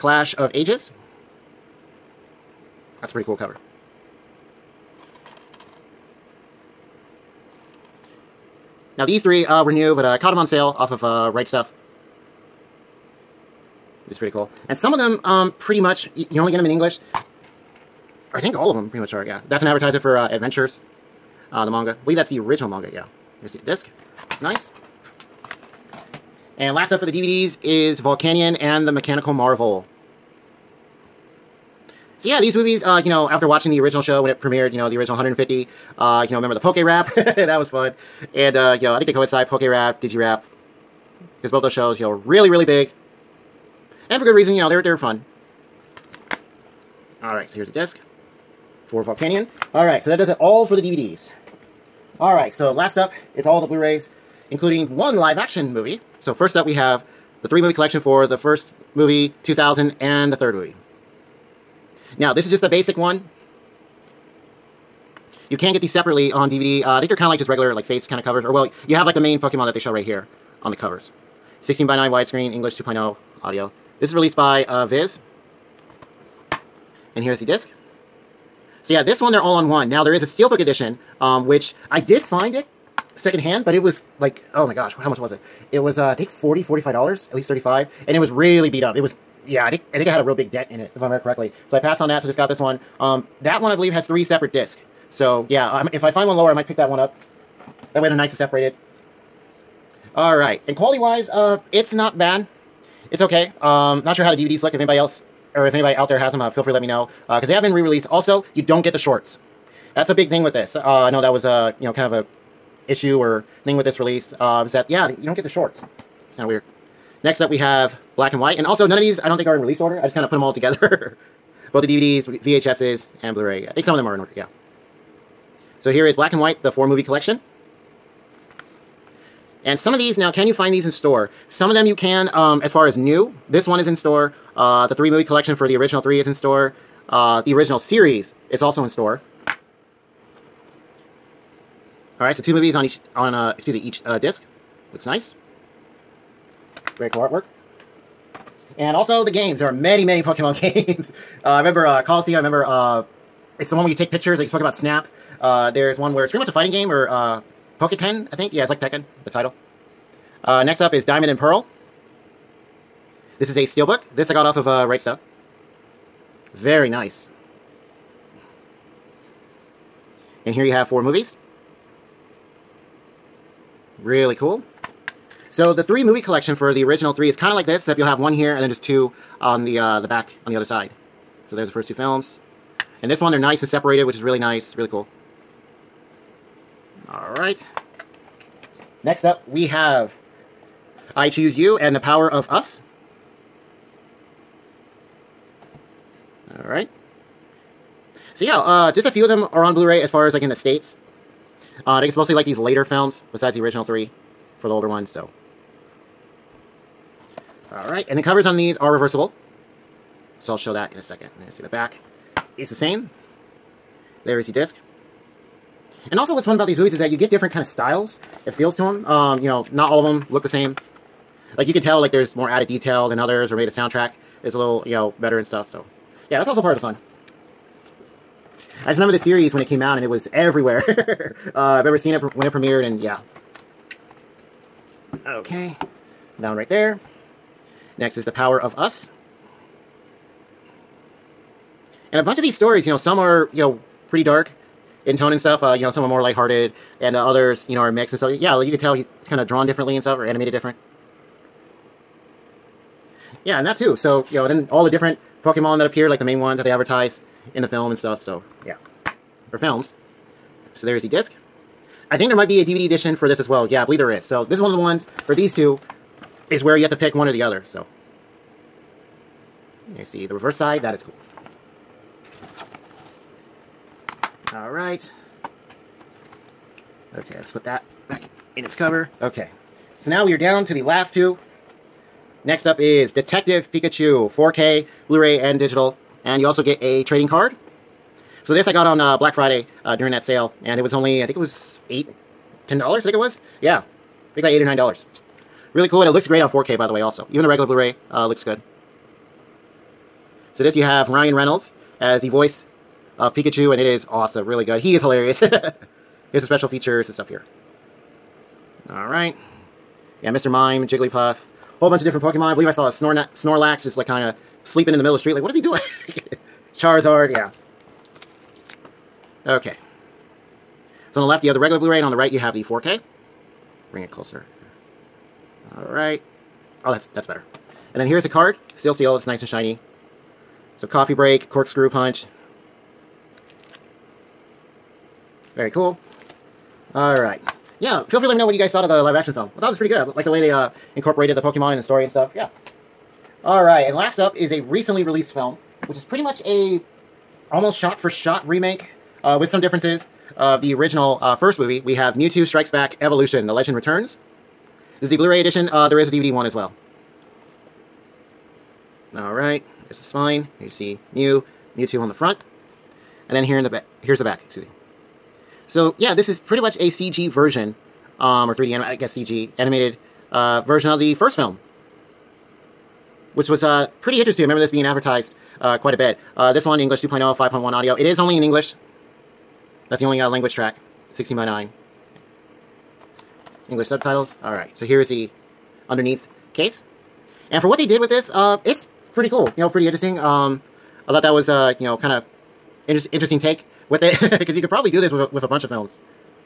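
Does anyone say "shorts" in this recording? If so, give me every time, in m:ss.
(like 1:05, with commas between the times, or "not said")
1:48, 1:55.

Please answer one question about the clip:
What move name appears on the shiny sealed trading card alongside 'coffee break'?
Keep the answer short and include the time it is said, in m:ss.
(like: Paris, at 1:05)
corkscrew punch, at 5:31.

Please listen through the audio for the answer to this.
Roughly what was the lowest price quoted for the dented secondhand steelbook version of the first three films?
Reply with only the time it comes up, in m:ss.
1:27.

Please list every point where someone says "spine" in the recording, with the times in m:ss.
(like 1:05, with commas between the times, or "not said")
6:00.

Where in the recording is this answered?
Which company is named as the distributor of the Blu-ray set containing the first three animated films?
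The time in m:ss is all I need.
1:14.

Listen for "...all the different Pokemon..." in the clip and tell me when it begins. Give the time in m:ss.
4:14.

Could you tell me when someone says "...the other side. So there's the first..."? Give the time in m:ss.
3:00.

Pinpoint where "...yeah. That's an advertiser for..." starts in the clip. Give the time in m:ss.
0:19.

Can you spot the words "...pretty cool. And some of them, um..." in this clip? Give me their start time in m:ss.
0:14.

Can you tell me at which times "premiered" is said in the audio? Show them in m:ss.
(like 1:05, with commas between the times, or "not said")
0:34, 3:52.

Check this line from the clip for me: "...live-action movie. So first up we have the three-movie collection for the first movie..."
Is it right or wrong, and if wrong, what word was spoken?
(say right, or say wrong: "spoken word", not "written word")
right.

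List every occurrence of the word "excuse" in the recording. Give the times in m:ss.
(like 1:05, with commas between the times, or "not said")
2:23, 6:04.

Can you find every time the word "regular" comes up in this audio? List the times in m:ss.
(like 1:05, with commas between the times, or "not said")
1:07, 4:57, 5:21.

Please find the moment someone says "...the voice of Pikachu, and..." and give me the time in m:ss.
5:02.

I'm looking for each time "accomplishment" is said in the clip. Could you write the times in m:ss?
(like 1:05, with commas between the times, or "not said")
not said.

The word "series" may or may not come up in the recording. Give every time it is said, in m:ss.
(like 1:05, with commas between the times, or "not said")
2:17, 3:49.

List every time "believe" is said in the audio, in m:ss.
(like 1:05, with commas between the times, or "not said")
0:22, 1:33, 4:23, 5:12.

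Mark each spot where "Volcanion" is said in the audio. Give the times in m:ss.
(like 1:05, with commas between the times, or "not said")
0:27, 0:49.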